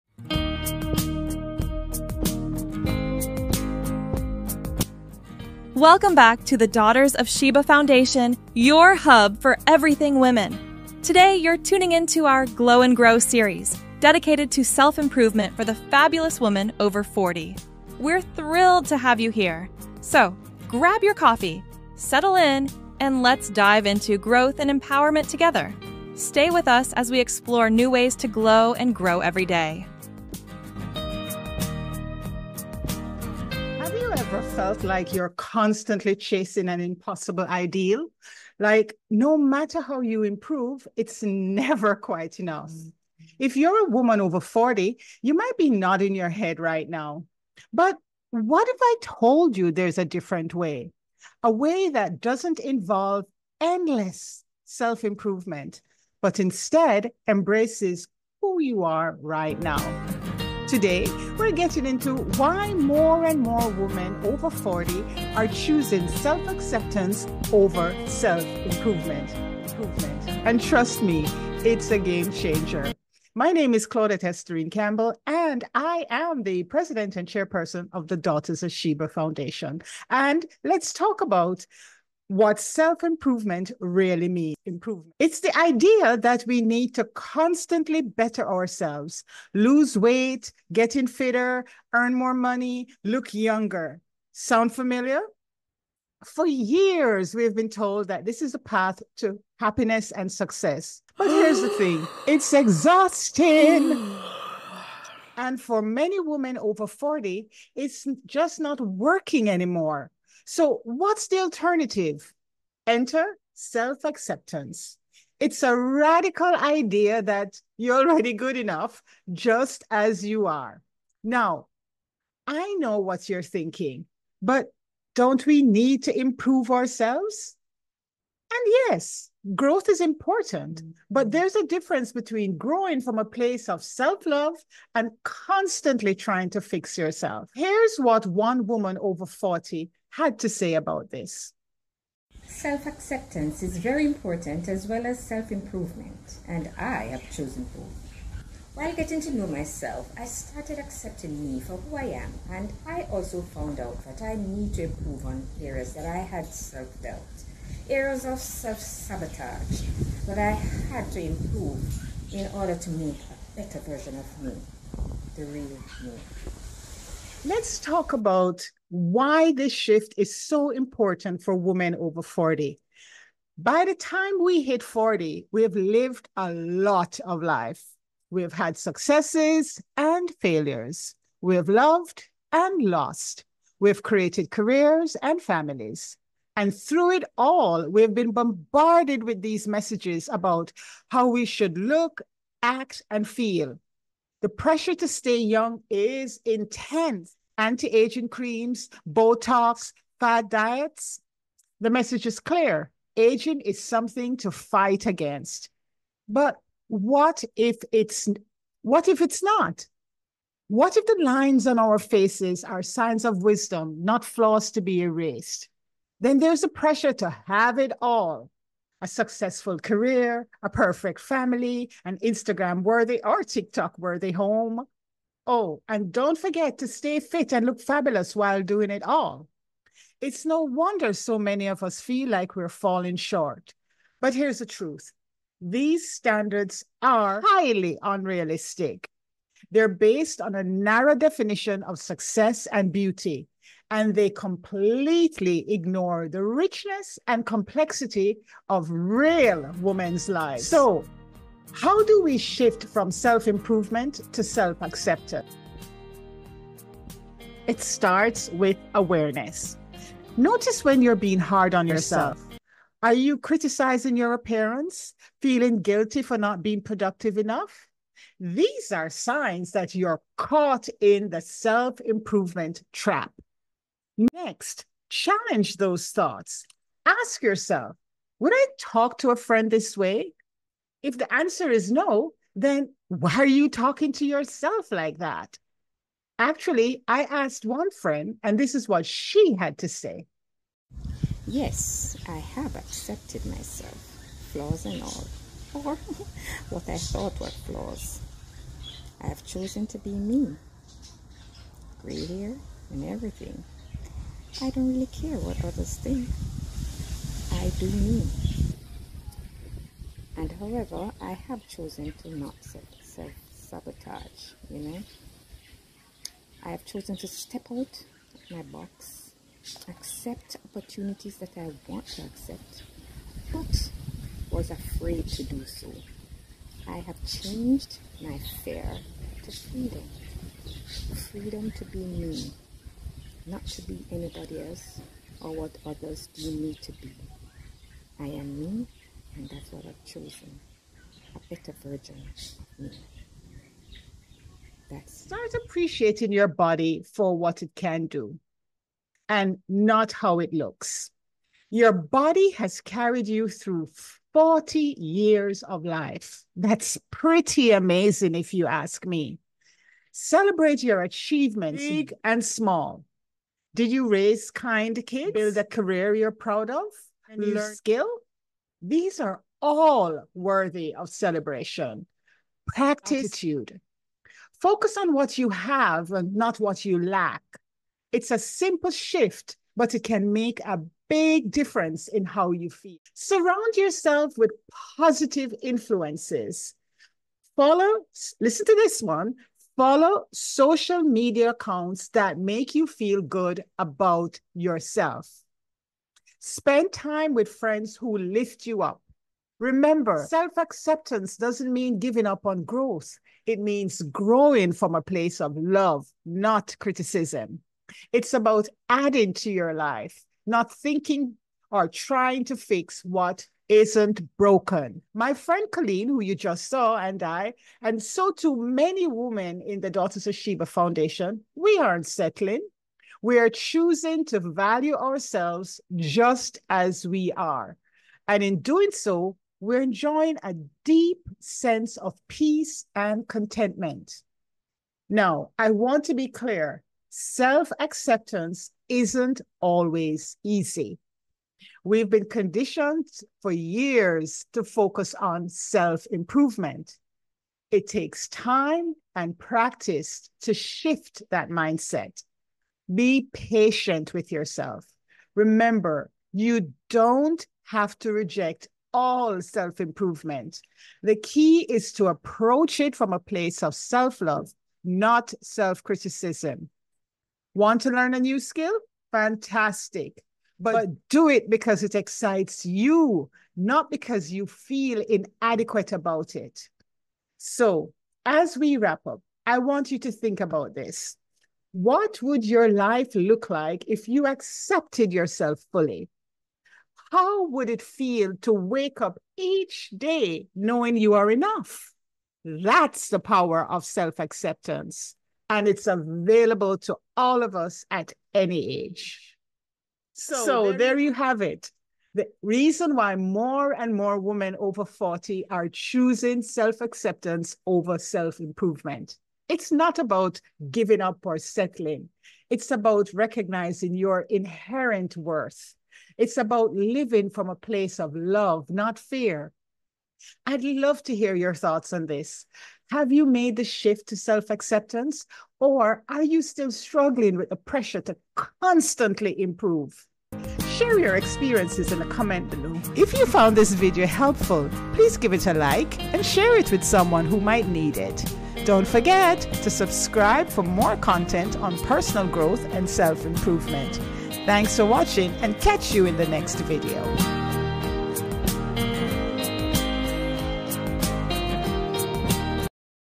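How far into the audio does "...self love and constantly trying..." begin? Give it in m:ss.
2:13.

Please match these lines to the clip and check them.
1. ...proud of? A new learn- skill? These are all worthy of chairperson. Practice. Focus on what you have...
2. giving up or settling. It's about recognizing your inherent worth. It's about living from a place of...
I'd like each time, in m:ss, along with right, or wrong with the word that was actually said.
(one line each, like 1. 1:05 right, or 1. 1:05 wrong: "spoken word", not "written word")
1. 6:06 wrong: "celebration", not "chairperson"
2. 8:30 right.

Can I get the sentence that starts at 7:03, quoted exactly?
We are choosing to value ourselves just as we are.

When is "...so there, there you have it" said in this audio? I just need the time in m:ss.
8:20.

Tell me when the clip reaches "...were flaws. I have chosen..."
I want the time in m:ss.
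4:57.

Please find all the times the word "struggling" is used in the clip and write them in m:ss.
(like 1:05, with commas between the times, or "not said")
8:46.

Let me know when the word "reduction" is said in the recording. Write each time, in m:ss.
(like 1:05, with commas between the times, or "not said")
not said.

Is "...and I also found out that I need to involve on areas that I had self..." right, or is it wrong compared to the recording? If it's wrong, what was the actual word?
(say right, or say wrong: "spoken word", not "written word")
wrong: "improve", not "involve".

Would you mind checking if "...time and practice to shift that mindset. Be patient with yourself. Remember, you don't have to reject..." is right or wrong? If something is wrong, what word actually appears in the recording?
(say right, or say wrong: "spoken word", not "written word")
right.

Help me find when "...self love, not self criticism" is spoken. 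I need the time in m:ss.
7:43.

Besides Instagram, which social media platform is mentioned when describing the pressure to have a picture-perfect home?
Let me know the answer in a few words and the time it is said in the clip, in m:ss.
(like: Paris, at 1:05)
TikTok, at 3:43.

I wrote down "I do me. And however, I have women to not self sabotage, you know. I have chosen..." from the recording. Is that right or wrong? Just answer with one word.
wrong.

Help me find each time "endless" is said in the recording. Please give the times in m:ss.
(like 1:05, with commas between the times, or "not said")
0:53.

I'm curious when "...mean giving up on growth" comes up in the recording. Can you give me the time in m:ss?
6:41.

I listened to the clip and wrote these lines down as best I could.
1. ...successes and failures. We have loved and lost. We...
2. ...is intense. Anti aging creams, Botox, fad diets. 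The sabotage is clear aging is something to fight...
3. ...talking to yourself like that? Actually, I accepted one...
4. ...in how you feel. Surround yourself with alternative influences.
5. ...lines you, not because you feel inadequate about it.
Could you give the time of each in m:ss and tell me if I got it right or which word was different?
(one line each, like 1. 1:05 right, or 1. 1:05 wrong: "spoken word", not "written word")
1. 2:58 right
2. 3:15 wrong: "message", not "sabotage"
3. 4:43 wrong: "asked", not "accepted"
4. 6:22 wrong: "positive", not "alternative"
5. 7:51 wrong: "excites", not "lines".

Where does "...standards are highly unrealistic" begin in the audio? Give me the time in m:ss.
3:56.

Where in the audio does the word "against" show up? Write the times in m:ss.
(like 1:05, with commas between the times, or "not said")
3:25.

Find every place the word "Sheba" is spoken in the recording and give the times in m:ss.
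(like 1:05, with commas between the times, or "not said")
0:07, 1:18, 7:00.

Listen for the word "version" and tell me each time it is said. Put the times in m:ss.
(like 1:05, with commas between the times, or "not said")
2:43, 5:41.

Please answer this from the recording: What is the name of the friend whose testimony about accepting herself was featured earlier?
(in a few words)
Colleen.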